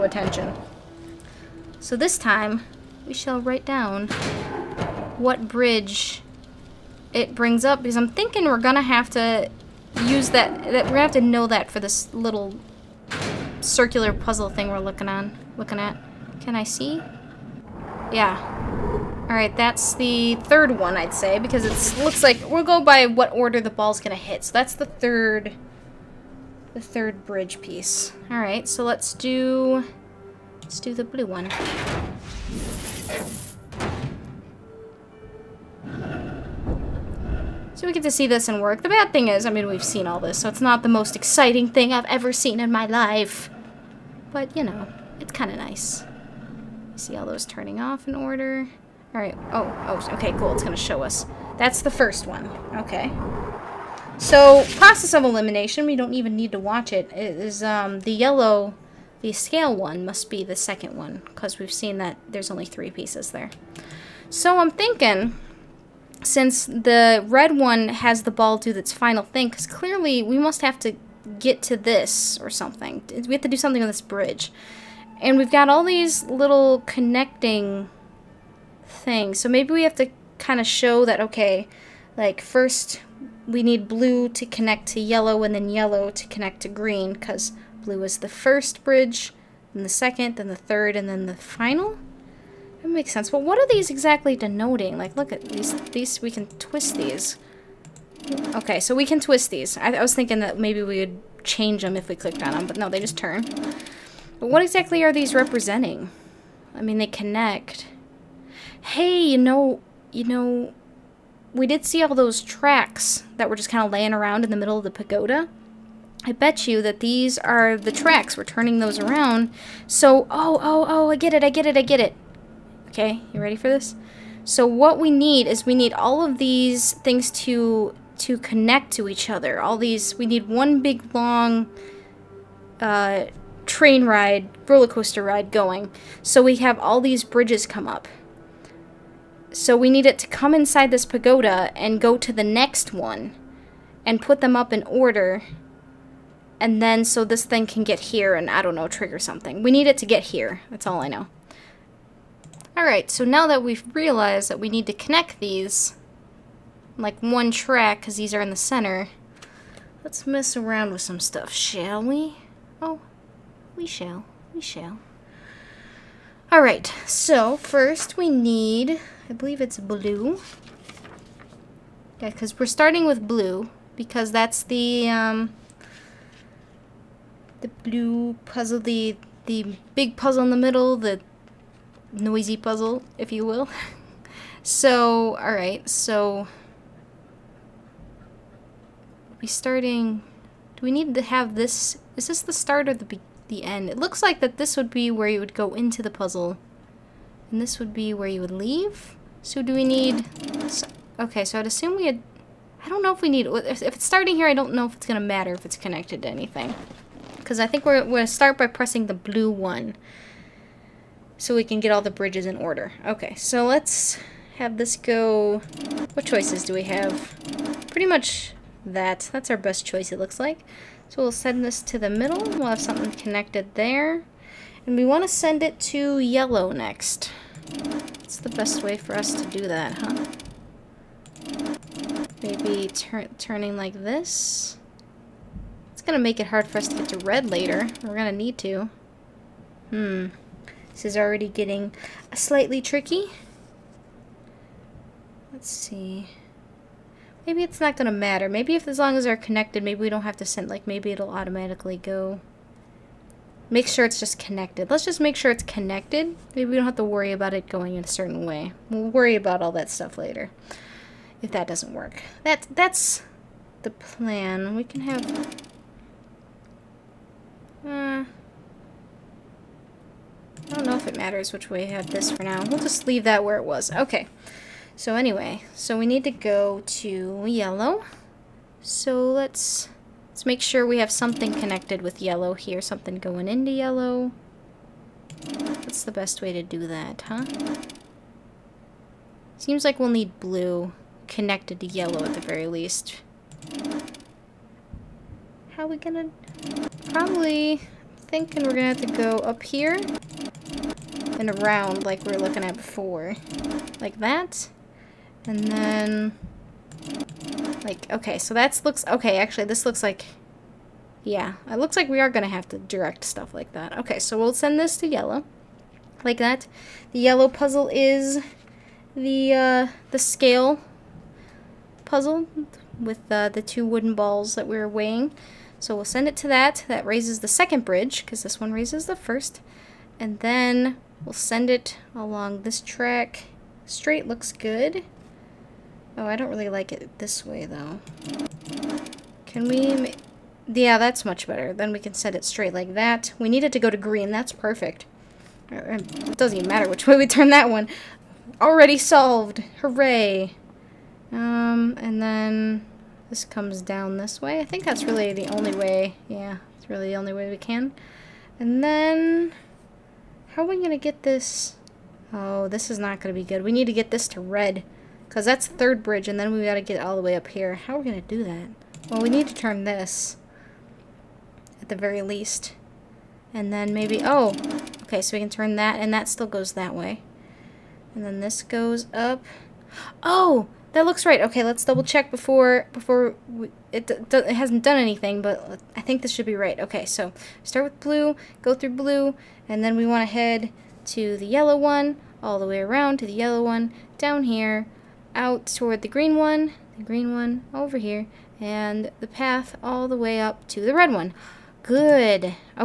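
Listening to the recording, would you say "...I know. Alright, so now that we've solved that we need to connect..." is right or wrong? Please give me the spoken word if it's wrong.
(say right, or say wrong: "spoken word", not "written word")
wrong: "realized", not "solved".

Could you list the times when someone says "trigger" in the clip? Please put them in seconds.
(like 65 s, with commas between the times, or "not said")
148 s.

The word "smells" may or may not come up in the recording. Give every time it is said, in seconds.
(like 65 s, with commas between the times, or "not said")
not said.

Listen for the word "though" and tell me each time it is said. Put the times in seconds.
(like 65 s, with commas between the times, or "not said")
337 s.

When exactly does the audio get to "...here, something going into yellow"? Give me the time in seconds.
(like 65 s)
282 s.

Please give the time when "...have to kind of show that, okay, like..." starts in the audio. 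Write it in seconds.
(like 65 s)
79 s.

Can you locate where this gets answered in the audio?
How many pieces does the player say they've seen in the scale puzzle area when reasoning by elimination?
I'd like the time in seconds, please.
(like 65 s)
62 s.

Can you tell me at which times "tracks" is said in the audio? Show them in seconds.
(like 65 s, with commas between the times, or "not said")
112 s, 117 s, 157 s, 332 s.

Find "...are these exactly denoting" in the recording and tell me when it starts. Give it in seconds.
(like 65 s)
93 s.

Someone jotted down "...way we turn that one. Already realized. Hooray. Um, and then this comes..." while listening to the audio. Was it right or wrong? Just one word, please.
wrong.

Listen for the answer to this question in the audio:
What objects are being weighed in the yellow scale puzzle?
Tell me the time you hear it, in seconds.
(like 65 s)
323 s.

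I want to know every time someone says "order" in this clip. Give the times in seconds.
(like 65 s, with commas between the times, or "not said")
23 s, 48 s, 144 s, 212 s.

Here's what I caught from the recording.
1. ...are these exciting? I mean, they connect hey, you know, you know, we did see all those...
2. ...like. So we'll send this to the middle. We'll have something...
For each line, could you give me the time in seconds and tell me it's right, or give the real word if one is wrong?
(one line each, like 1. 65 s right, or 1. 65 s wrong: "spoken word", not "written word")
1. 105 s wrong: "representing", not "exciting"
2. 220 s right.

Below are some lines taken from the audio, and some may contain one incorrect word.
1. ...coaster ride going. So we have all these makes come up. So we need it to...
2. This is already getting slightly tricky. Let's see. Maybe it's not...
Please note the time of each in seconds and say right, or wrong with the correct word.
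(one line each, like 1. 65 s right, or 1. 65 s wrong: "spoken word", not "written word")
1. 134 s wrong: "bridges", not "makes"
2. 240 s right.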